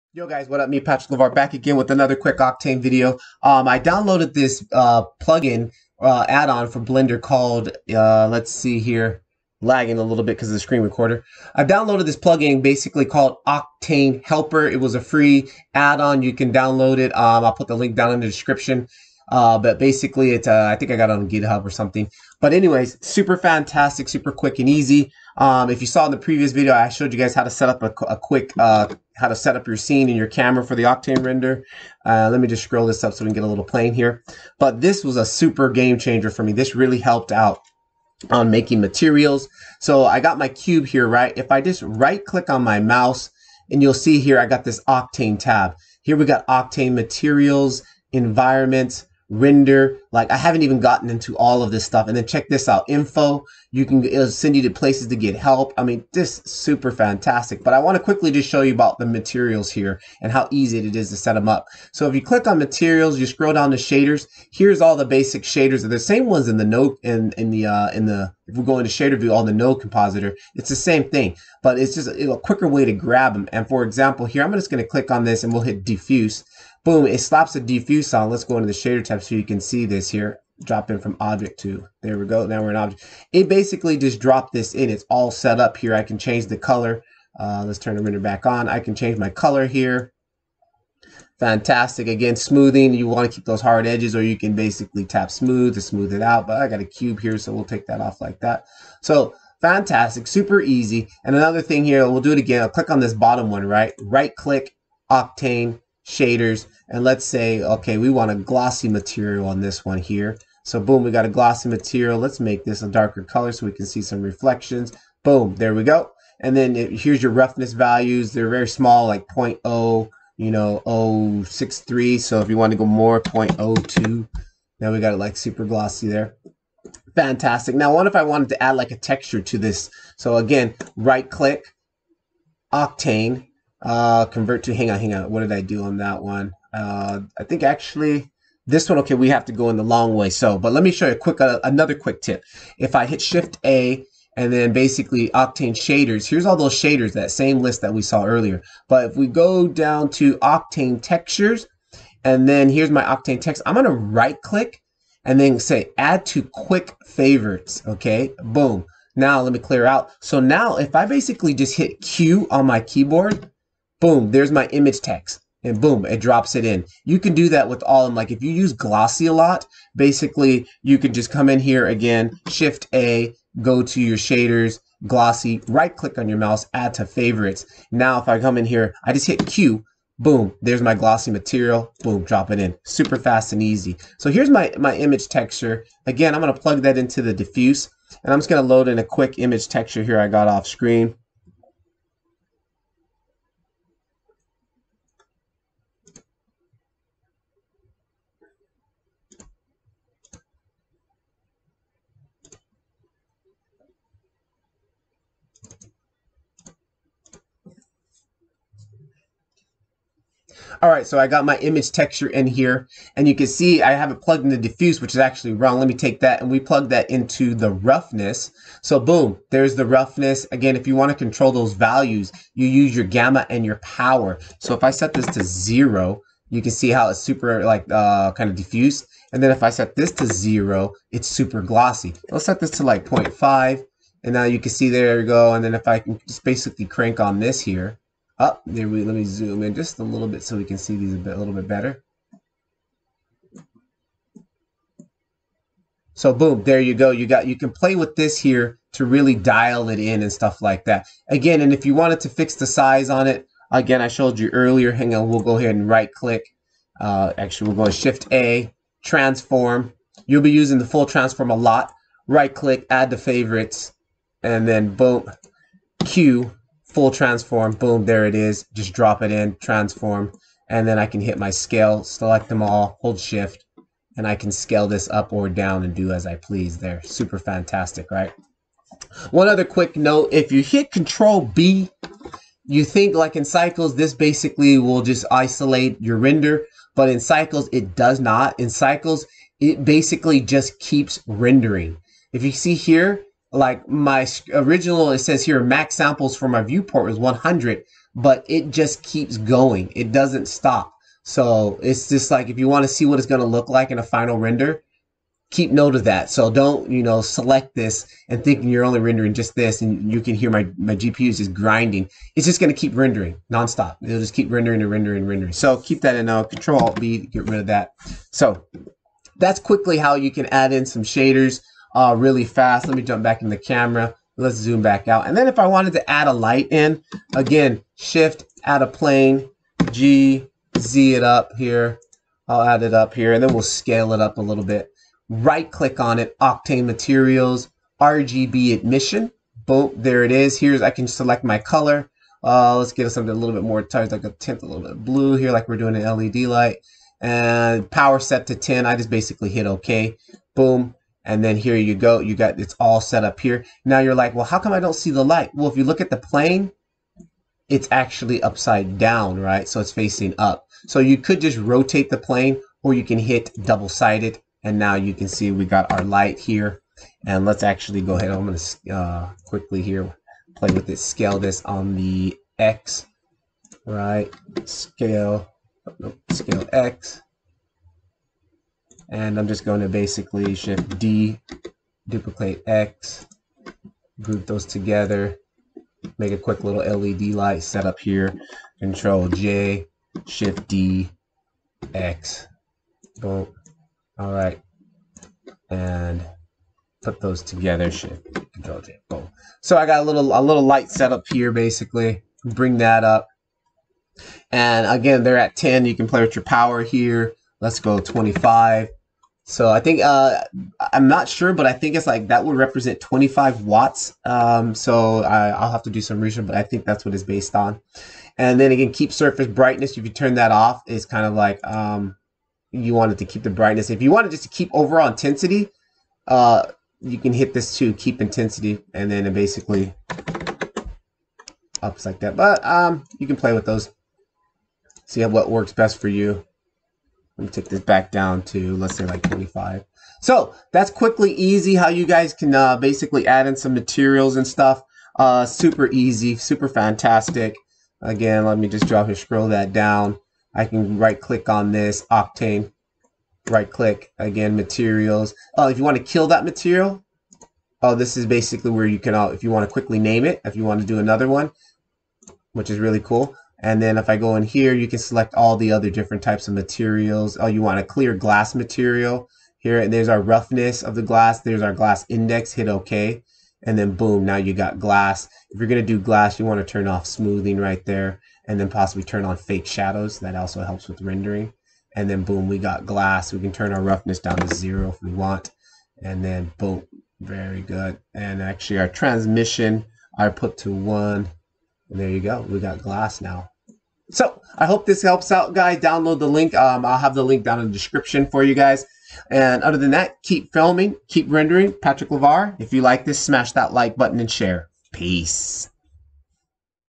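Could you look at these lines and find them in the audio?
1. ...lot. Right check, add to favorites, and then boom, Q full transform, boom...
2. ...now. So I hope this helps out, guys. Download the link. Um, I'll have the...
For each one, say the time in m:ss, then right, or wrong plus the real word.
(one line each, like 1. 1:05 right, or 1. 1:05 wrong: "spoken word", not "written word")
1. 4:21 wrong: "click", not "check"
2. 8:13 right.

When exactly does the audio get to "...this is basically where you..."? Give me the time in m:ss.
7:37.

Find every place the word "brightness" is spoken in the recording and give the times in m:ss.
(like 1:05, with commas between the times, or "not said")
6:59, 7:03.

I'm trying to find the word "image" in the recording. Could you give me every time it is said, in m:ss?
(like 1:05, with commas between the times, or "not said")
2:44, 3:04, 3:09, 3:31.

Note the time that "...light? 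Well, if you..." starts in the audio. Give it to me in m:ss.
5:55.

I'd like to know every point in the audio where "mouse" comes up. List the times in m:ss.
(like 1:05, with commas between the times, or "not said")
0:42, 2:56.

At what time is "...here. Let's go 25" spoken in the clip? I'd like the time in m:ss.
6:46.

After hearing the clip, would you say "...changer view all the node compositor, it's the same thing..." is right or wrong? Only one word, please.
wrong.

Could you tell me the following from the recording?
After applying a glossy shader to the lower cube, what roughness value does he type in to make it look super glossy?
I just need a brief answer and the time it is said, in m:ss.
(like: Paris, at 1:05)
0.02, at 2:03.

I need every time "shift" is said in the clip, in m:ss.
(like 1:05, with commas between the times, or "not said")
2:23, 2:52, 4:17, 4:33, 5:27, 6:20, 6:30, 6:37.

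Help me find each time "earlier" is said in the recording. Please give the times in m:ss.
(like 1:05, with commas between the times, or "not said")
2:28, 4:14.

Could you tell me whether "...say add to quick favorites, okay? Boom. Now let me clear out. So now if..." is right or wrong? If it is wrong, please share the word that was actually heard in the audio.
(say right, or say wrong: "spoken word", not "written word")
right.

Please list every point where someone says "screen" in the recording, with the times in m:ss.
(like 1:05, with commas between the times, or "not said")
0:10, 3:10.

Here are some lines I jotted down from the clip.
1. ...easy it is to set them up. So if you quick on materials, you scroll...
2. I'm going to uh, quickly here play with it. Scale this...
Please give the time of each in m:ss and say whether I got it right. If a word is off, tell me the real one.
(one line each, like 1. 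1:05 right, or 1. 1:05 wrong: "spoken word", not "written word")
1. 1:00 wrong: "click", not "quick"
2. 6:08 right.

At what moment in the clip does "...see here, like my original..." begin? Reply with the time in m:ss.
4:52.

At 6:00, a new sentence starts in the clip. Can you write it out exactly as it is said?
So you could just rotate the plane or you can hit double sided.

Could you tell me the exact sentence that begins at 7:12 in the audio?
But um, you can play with those, see what works best for you.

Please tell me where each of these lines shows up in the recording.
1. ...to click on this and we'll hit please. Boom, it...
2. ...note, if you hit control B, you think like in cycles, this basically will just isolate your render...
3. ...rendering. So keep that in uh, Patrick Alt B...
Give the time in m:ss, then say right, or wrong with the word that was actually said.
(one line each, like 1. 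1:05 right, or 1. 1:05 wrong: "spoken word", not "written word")
1. 1:14 wrong: "diffuse", not "please"
2. 4:39 right
3. 5:15 wrong: "Control", not "Patrick".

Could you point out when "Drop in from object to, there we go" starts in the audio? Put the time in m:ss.
1:20.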